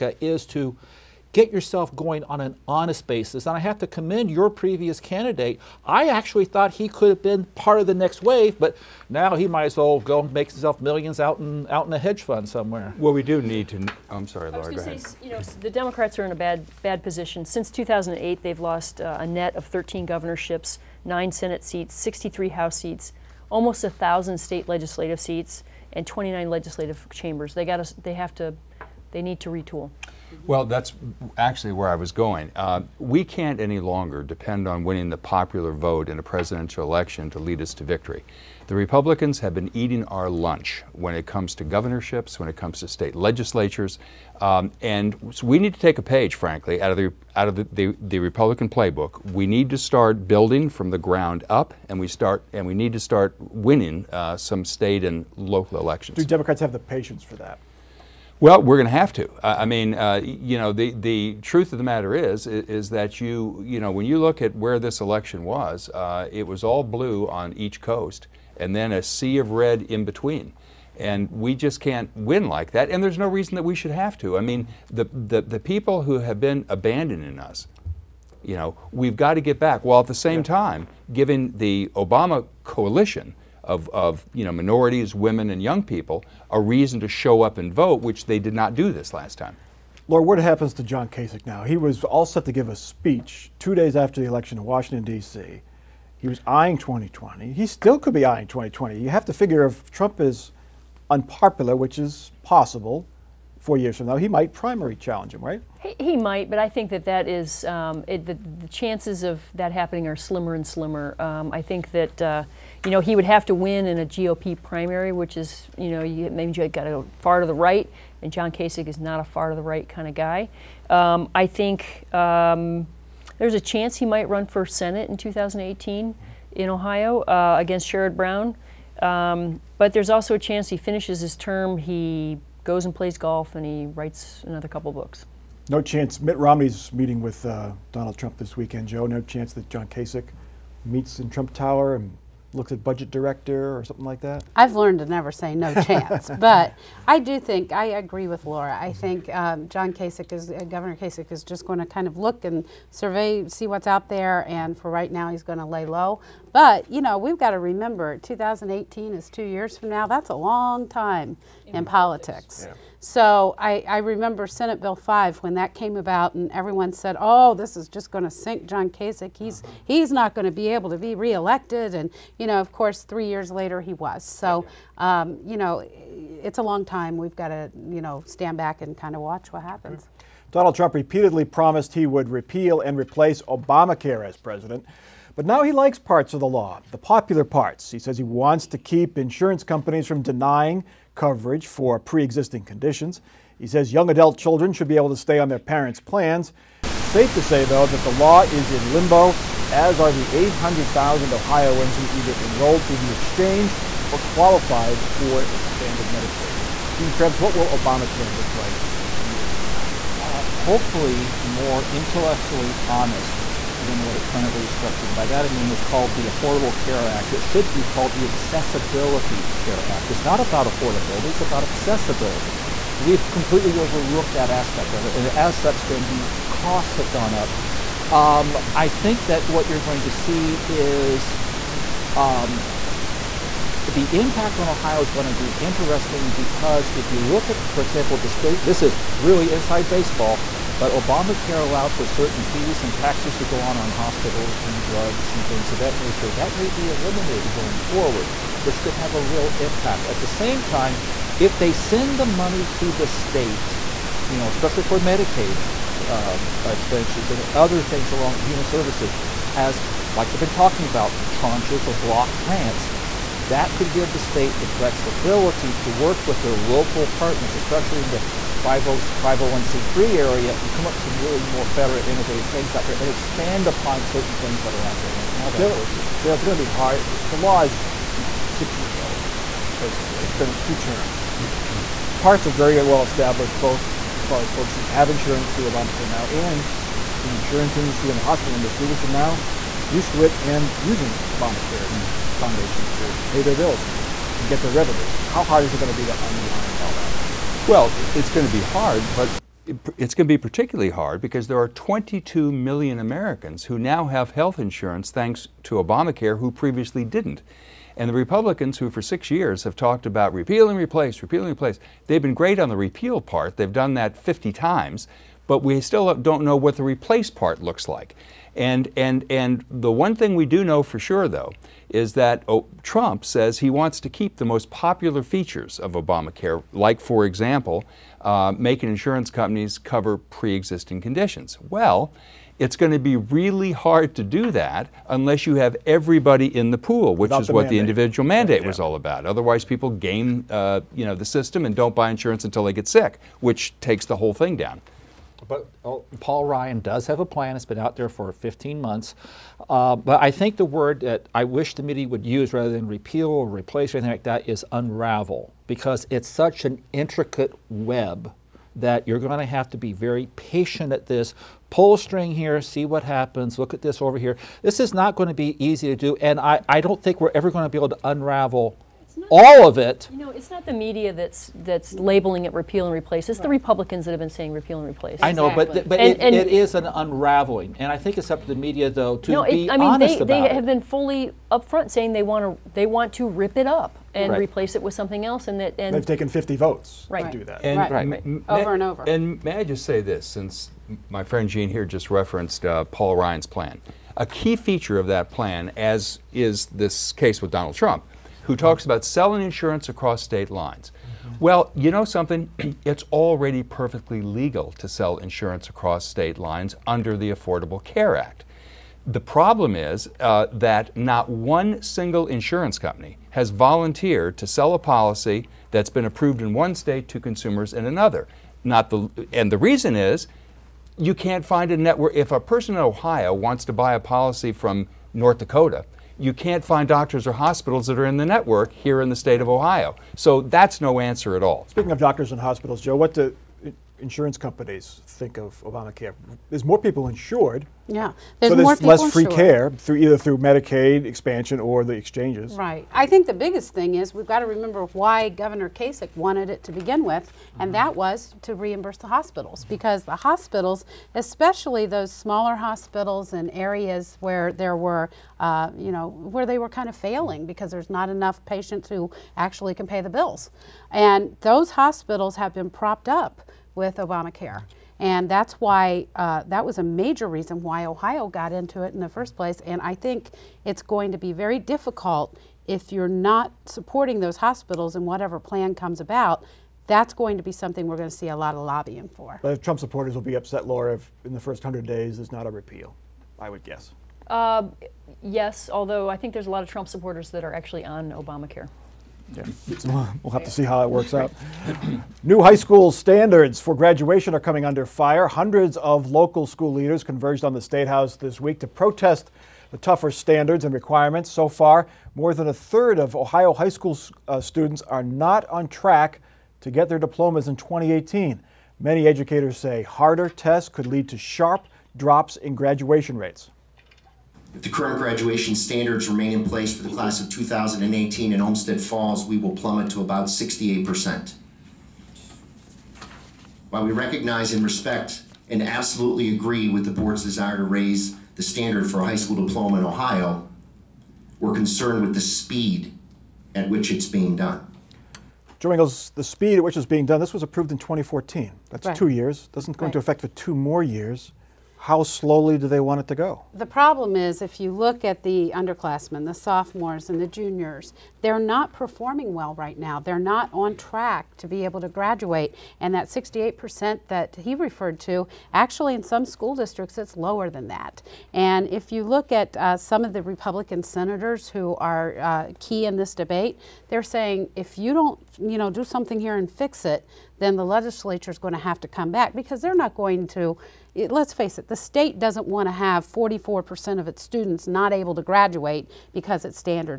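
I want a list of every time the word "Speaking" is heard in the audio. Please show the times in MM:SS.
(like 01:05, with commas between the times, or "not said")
07:11.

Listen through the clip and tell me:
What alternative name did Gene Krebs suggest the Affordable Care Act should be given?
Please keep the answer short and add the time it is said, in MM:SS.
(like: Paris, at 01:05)
Accessibility Care Act, at 03:38.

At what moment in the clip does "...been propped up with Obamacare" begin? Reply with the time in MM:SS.
07:42.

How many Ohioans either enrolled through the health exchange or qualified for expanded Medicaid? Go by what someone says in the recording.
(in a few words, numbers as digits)
800,000.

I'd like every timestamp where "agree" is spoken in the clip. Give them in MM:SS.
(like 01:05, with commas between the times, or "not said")
02:27, 08:46.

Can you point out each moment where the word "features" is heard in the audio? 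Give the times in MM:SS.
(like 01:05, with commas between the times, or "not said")
05:25, 06:34.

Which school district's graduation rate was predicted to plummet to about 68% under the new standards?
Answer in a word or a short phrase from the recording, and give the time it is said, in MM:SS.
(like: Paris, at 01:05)
Olmsted Falls, at 08:38.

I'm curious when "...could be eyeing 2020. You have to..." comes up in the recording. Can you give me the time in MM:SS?
01:37.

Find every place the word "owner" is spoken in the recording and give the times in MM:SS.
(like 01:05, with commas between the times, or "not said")
not said.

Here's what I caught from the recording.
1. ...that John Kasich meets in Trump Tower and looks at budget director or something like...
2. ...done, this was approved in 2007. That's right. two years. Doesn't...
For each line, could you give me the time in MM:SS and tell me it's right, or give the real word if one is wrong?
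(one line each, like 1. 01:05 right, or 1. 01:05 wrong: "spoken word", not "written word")
1. 02:19 right
2. 08:57 wrong: "2014", not "2007".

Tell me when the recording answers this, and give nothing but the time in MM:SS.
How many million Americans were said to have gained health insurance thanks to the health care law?
05:01.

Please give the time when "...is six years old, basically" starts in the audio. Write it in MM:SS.
04:37.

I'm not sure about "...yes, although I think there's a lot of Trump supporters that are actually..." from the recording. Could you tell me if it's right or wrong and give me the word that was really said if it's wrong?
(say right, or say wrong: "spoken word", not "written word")
right.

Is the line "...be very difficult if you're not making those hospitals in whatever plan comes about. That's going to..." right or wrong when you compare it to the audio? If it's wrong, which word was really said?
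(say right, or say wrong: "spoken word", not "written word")
wrong: "supporting", not "making".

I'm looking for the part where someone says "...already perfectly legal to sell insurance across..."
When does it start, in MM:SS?
06:43.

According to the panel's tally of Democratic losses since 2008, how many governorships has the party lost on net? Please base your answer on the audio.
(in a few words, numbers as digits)
13.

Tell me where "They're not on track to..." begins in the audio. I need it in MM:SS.
09:09.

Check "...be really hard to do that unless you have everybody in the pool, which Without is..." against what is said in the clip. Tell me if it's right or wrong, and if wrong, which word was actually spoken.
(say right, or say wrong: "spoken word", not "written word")
right.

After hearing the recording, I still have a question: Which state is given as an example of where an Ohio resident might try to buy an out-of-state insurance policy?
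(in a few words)
North Dakota.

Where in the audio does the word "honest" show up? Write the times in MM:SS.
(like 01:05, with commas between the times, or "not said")
00:02, 03:32.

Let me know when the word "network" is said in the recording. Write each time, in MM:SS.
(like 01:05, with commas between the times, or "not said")
07:01, 07:08.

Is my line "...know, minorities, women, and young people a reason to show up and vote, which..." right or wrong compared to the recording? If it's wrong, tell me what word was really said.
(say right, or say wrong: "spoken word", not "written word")
right.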